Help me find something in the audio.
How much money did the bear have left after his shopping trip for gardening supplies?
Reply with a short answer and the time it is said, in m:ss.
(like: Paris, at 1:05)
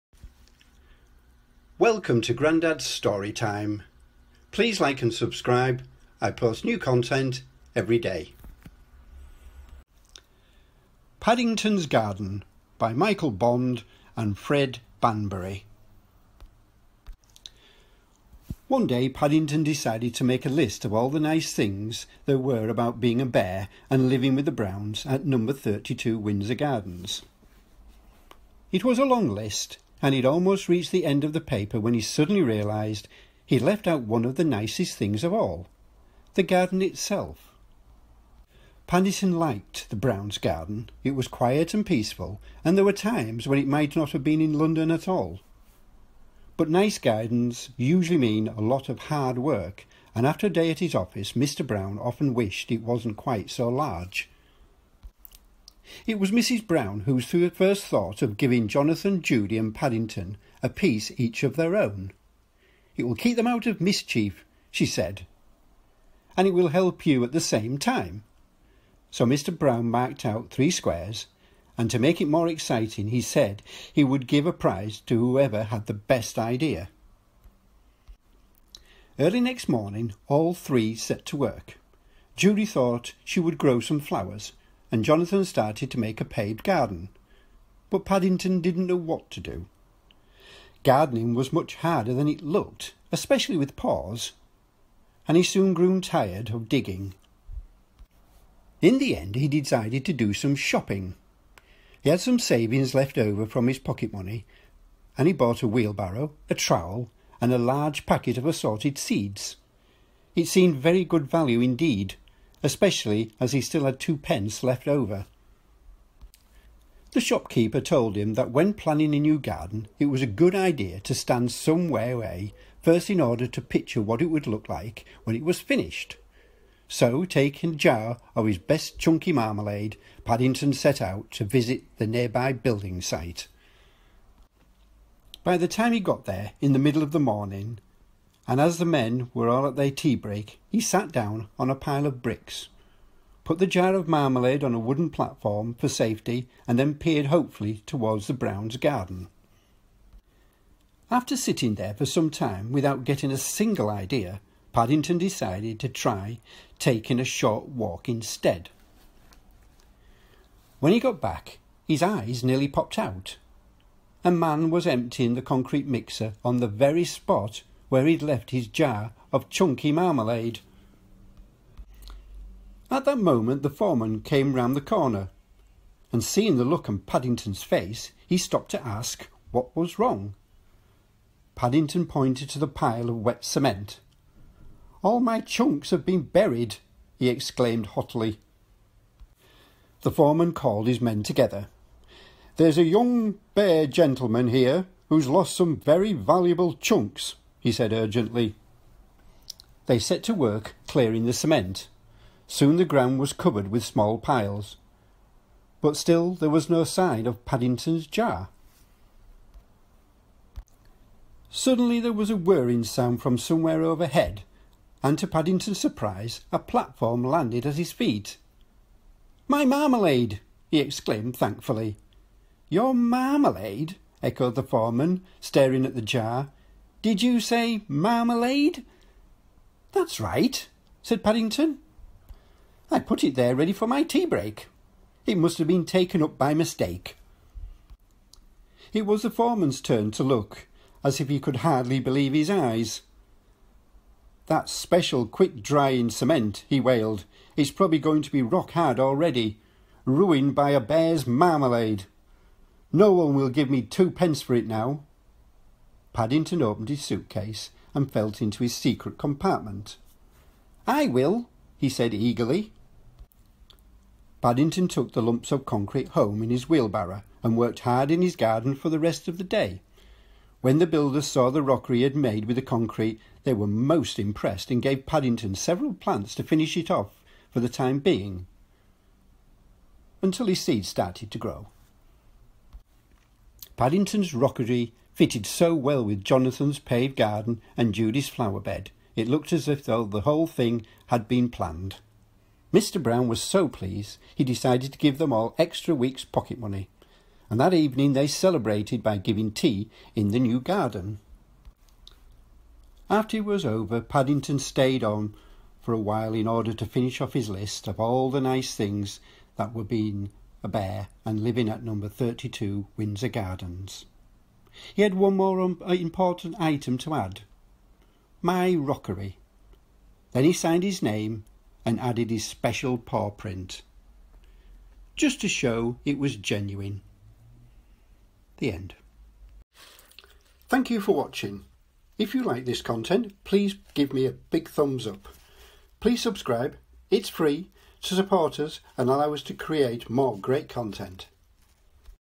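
2 pence, at 1:53.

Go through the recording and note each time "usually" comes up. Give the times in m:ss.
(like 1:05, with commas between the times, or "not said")
0:47.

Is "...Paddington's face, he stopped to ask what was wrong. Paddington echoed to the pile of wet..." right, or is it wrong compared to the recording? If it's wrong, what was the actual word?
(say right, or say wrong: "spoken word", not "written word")
wrong: "pointed", not "echoed".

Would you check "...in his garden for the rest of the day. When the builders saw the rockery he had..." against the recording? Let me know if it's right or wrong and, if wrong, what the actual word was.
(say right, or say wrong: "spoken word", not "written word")
right.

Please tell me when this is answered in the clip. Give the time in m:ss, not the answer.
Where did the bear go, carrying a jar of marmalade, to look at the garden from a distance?
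2:12.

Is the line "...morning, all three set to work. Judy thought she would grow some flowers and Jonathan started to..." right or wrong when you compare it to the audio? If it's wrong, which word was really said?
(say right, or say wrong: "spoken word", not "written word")
right.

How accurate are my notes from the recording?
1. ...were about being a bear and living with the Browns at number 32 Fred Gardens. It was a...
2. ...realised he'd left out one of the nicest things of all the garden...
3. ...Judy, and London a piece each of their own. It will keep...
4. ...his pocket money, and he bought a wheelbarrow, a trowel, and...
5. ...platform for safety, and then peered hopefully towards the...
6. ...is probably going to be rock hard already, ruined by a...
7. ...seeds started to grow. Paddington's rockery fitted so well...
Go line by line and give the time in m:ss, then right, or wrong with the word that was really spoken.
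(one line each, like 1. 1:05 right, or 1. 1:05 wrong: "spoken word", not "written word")
1. 0:22 wrong: "Windsor", not "Fred"
2. 0:32 right
3. 0:59 wrong: "Paddington", not "London"
4. 1:43 right
5. 2:25 right
6. 4:07 right
7. 4:40 right.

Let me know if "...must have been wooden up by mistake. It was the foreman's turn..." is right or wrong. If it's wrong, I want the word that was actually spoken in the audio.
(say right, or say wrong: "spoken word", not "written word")
wrong: "taken", not "wooden".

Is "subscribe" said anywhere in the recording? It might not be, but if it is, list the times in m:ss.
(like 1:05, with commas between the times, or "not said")
0:05, 5:36.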